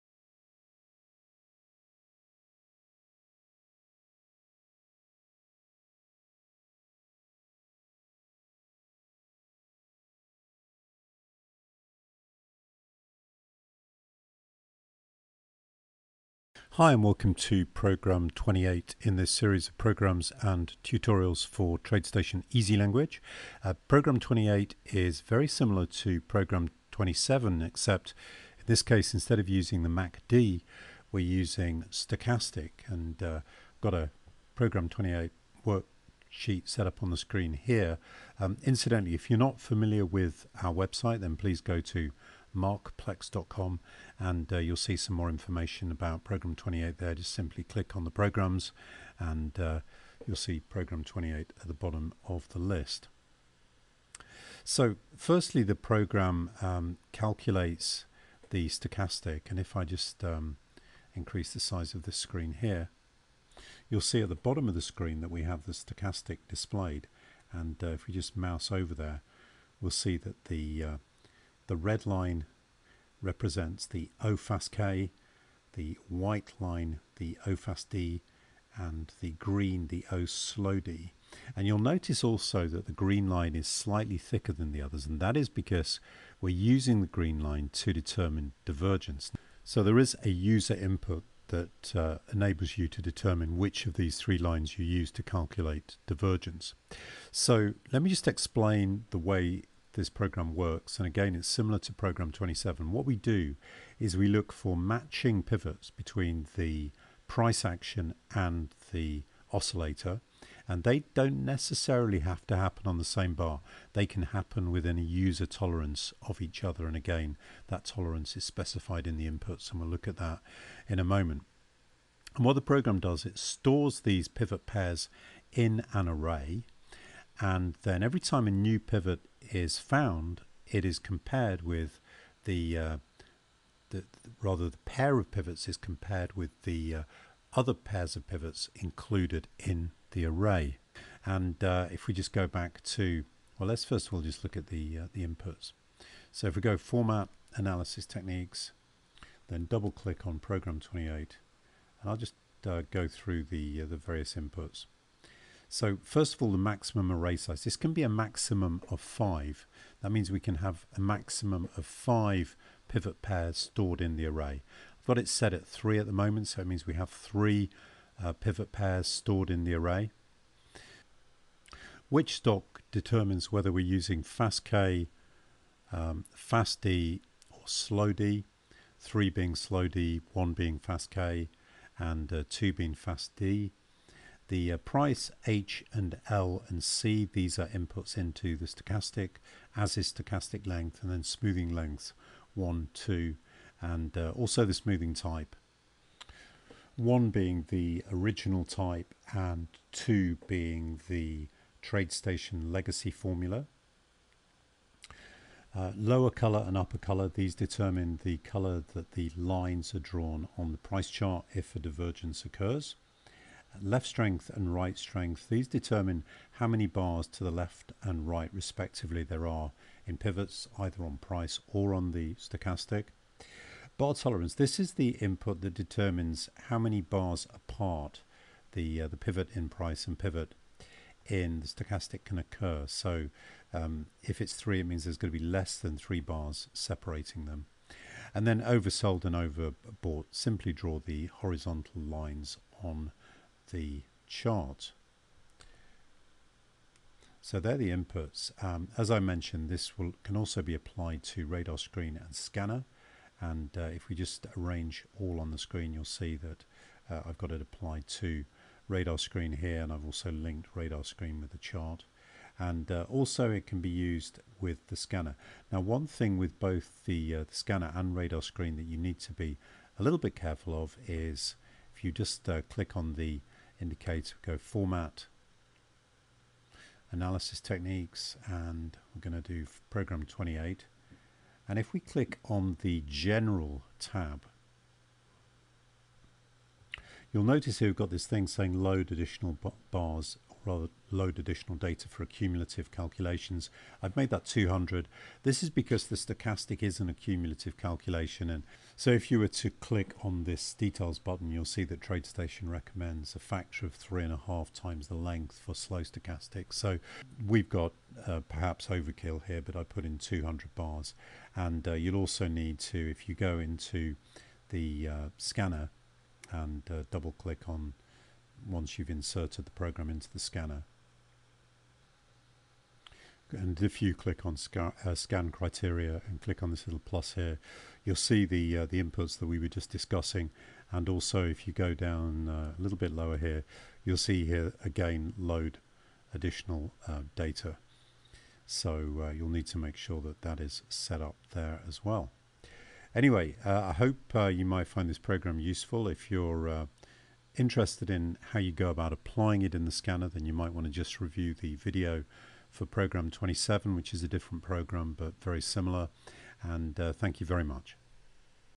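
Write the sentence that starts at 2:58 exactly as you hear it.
three being slow D, one being fast K, and uh, two being fast D the uh, price H and L and C.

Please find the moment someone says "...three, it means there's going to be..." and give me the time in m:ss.
3:54.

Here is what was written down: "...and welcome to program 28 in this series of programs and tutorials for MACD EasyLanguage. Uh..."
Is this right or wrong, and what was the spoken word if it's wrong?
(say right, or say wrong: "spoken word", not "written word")
wrong: "TradeStation", not "MACD".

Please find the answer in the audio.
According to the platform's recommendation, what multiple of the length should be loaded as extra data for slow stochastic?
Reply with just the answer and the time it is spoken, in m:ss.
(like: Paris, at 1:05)
3.5 times, at 5:03.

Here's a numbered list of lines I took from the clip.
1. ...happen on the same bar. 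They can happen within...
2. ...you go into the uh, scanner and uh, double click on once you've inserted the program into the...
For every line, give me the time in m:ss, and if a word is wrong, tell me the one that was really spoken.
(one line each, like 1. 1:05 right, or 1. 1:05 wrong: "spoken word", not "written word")
1. 1:52 right
2. 5:13 right.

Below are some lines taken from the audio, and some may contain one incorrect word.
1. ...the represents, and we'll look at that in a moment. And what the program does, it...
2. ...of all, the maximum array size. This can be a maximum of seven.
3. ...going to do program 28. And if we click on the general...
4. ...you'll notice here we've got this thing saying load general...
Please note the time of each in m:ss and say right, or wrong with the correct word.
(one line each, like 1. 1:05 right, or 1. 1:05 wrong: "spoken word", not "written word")
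1. 1:59 wrong: "inputs", not "represents"
2. 2:36 wrong: "five", not "seven"
3. 4:39 right
4. 4:47 wrong: "additional", not "general".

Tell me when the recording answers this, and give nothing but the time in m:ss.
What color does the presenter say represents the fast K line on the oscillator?
1:11.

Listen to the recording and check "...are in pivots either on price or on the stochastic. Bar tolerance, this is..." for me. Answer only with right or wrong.
right.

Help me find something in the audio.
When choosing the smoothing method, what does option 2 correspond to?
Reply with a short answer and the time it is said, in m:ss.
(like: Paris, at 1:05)
TradeStation legacy formula, at 3:21.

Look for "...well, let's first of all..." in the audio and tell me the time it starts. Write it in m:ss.
2:23.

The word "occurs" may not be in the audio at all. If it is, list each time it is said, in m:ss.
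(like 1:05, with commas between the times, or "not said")
3:32, 3:52.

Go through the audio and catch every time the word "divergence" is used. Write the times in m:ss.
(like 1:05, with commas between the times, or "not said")
1:28, 1:36, 3:31.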